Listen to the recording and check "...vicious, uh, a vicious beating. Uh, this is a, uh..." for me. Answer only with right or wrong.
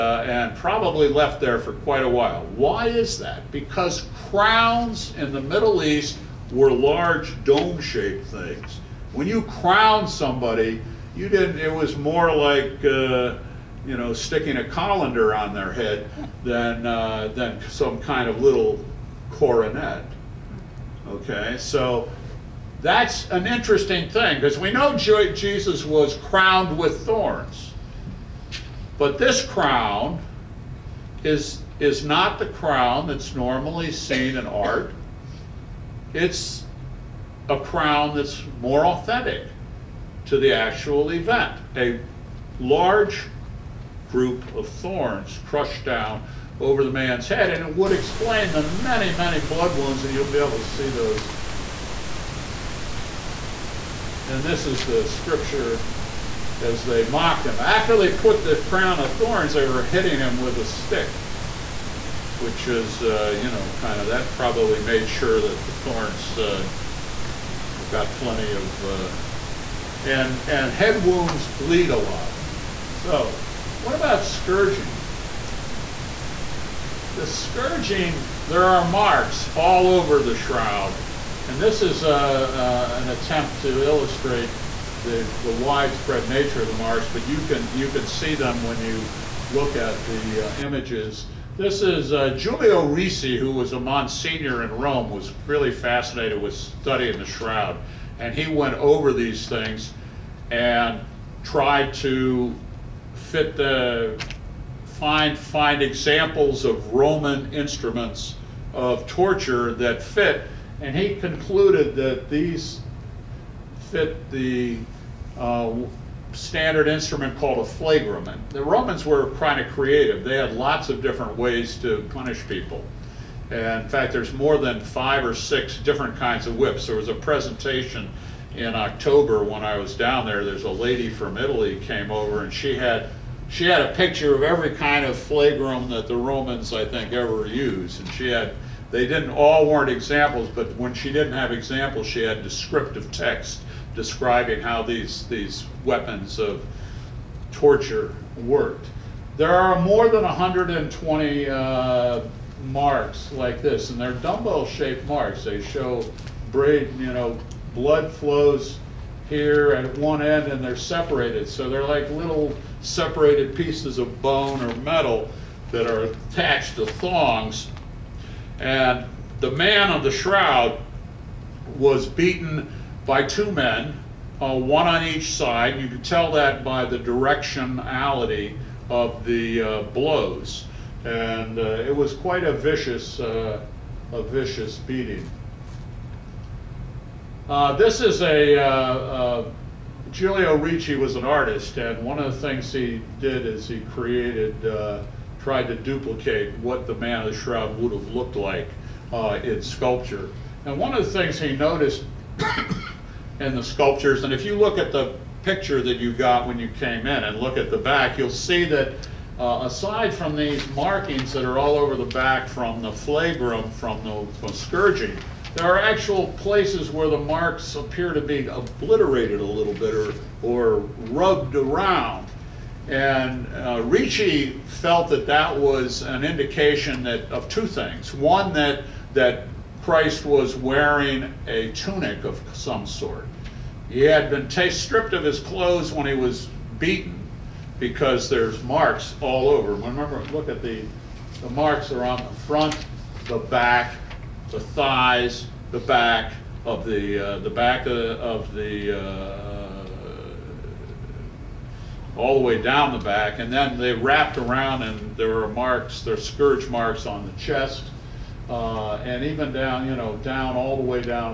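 right.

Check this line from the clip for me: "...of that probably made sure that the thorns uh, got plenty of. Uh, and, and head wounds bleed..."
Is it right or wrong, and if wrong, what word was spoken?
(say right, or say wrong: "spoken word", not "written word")
right.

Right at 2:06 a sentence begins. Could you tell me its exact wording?
There was a presentation in October when I was down there.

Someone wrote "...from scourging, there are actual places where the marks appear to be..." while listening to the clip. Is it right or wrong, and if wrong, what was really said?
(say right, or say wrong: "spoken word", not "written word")
right.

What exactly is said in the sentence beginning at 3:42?
And uh, Ricci felt that that was an indication that, of two things.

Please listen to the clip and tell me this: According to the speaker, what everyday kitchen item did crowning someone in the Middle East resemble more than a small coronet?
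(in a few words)
A colander.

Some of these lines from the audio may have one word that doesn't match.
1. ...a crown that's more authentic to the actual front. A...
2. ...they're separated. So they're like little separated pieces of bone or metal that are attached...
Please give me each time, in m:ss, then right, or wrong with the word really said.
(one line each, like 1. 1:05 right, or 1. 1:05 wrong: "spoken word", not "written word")
1. 0:37 wrong: "event", not "front"
2. 2:40 right.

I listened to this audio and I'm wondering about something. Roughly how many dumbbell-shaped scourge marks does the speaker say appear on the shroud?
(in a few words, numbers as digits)
More than 120.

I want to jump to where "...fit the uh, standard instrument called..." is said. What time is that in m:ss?
1:53.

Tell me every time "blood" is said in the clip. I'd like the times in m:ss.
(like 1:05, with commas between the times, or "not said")
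0:49, 2:37.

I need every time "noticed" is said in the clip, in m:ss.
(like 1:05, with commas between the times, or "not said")
3:21.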